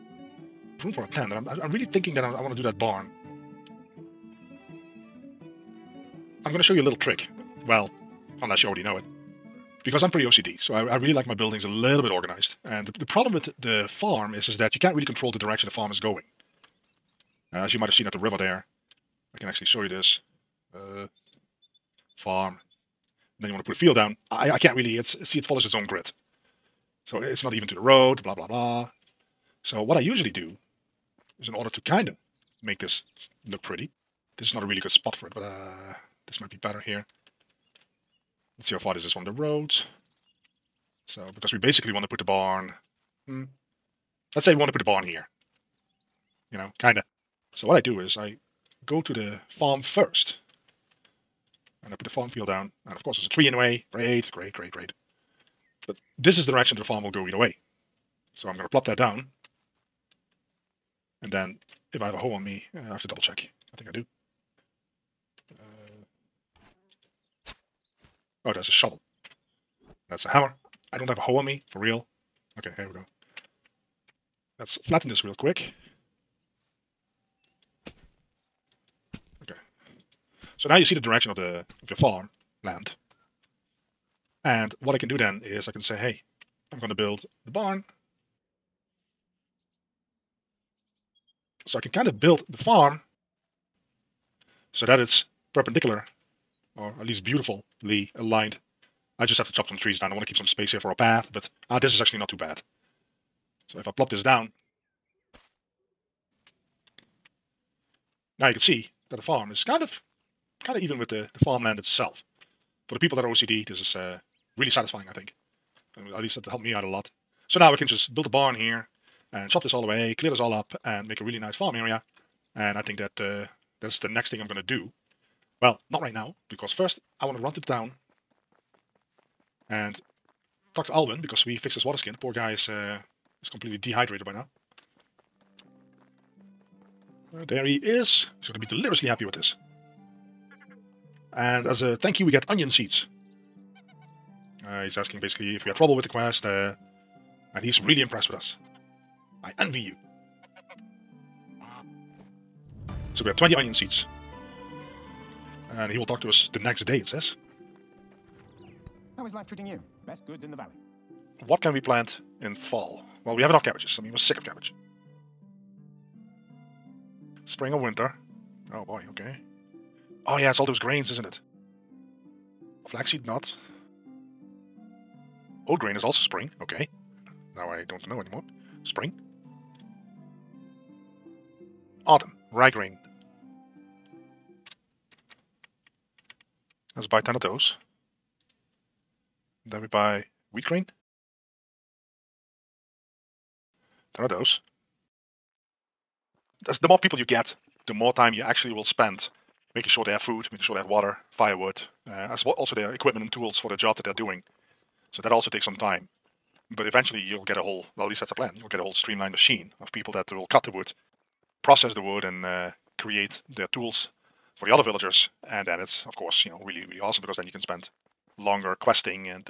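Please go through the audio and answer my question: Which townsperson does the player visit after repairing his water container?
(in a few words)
Alvin.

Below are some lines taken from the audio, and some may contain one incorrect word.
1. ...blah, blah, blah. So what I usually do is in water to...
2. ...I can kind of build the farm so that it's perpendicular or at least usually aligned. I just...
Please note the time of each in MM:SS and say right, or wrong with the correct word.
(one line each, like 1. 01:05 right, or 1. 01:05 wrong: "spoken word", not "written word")
1. 00:28 wrong: "order", not "water"
2. 01:31 wrong: "beautifully", not "usually".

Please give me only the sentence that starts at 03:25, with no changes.
So that also takes some time.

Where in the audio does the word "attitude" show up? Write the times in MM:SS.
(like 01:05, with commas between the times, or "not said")
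not said.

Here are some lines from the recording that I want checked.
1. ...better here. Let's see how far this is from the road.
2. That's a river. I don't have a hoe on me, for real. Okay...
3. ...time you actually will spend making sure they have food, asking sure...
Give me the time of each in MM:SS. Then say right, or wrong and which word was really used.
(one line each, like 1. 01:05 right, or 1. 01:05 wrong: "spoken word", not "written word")
1. 00:36 right
2. 01:10 wrong: "hammer", not "river"
3. 03:18 wrong: "making", not "asking".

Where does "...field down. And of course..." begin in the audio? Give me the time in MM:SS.
00:52.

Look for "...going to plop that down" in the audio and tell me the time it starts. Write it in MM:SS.
00:58.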